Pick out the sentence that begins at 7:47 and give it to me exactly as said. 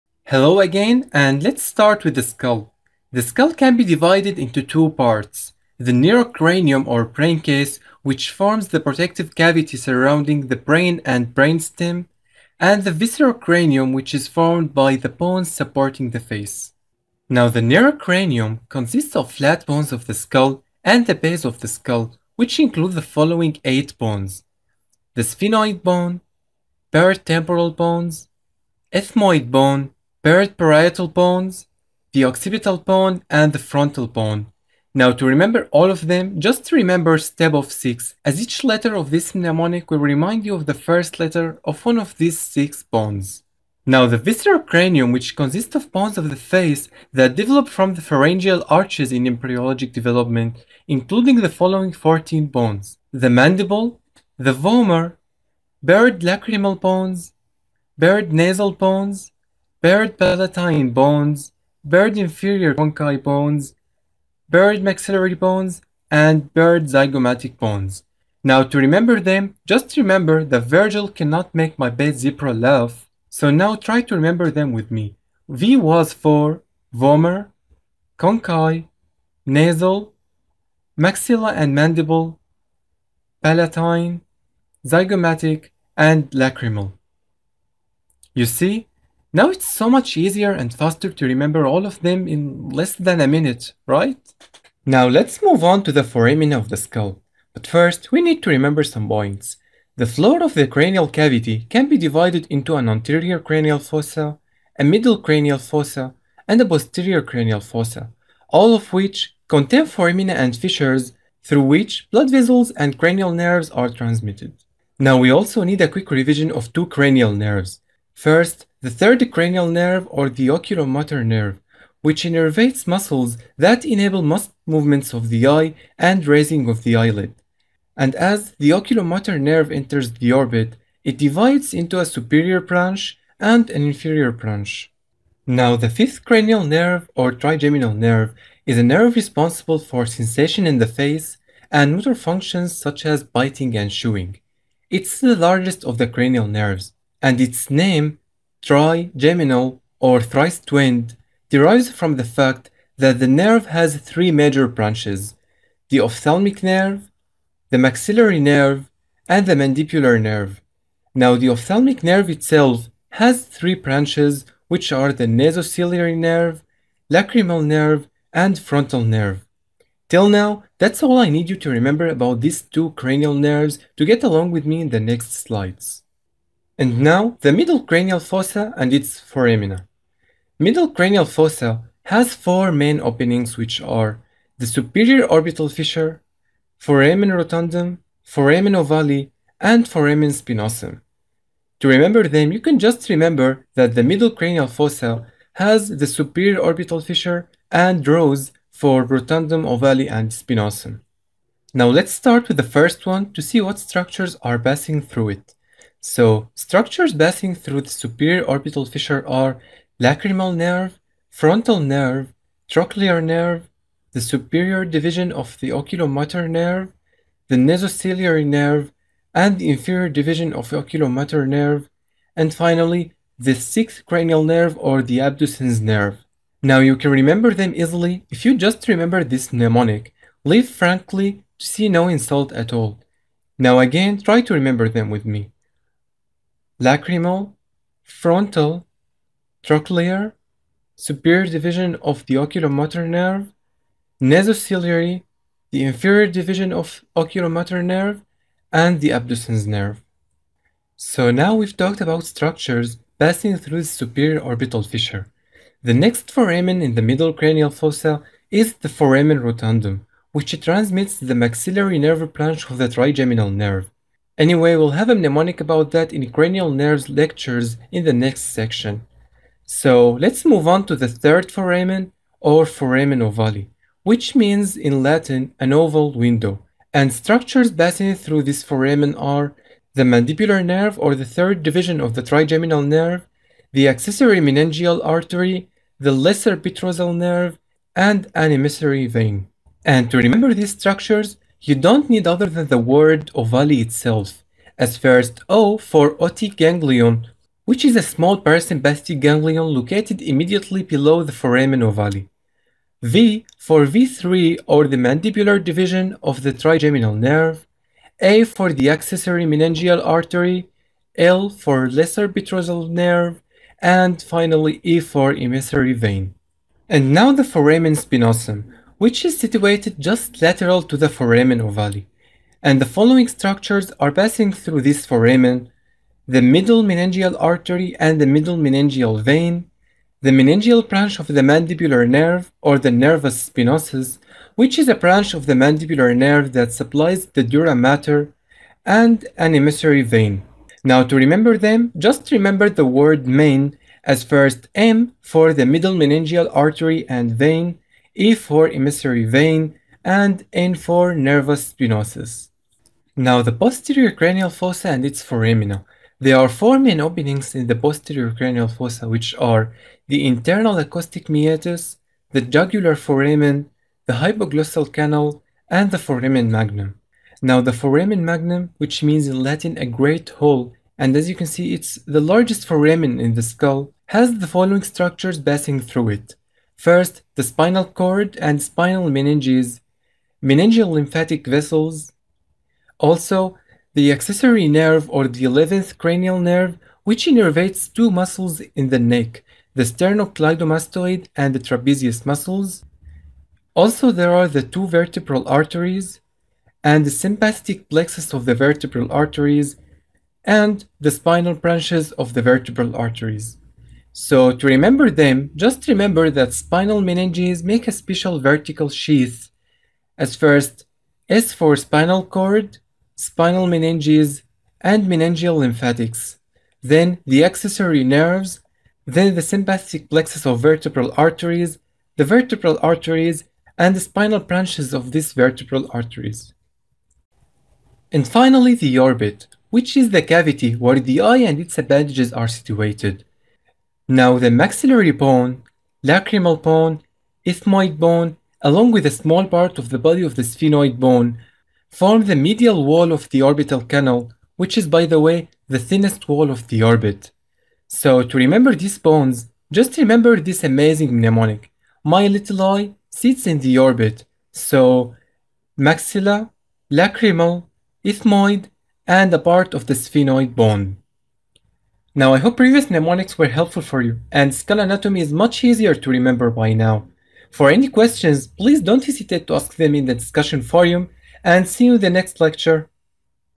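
For any questions, please don't hesitate to ask them in the discussion forum, and see you in the next lecture.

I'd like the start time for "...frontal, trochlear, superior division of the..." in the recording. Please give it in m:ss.
3:58.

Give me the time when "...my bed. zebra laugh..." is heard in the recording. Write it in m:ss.
1:11.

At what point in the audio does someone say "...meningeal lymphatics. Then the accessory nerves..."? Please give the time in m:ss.
6:55.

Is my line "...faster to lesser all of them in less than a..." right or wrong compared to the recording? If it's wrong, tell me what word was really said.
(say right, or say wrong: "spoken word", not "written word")
wrong: "remember", not "lesser".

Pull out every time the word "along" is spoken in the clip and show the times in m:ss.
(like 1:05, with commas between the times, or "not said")
2:54, 7:18.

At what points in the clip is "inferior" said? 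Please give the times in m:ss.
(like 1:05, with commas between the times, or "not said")
1:02, 2:13, 3:39, 4:05.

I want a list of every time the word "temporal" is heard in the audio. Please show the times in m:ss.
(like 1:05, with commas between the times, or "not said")
0:27.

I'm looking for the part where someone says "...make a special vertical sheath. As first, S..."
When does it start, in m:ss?
6:47.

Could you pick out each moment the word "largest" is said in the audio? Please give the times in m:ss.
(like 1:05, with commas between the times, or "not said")
2:25, 6:12.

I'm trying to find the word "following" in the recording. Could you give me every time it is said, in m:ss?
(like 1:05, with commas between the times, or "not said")
0:23, 0:51, 5:22, 6:14.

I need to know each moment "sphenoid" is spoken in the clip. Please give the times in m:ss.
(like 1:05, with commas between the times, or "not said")
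0:25, 7:20, 7:39.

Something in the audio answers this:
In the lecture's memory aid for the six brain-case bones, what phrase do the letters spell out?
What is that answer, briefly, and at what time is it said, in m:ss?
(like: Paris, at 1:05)
Step of 6, at 0:37.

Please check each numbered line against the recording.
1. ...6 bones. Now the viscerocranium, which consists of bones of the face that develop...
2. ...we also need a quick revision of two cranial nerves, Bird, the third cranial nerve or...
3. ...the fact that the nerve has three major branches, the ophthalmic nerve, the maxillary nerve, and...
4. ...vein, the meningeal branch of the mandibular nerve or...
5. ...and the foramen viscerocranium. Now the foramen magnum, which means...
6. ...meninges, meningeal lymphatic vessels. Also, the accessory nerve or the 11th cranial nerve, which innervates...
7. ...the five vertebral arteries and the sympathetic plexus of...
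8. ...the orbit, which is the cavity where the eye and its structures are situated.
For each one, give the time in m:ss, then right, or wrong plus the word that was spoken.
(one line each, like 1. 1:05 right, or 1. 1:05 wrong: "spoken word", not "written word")
1. 0:42 right
2. 1:55 wrong: "First", not "Bird"
3. 2:32 right
4. 5:29 right
5. 6:05 wrong: "magnum", not "viscerocranium"
6. 6:19 right
7. 6:34 wrong: "two", not "five"
8. 7:08 wrong: "appendages", not "structures".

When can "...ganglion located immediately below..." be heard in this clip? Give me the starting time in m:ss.
4:59.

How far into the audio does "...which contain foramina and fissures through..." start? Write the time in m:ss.
1:48.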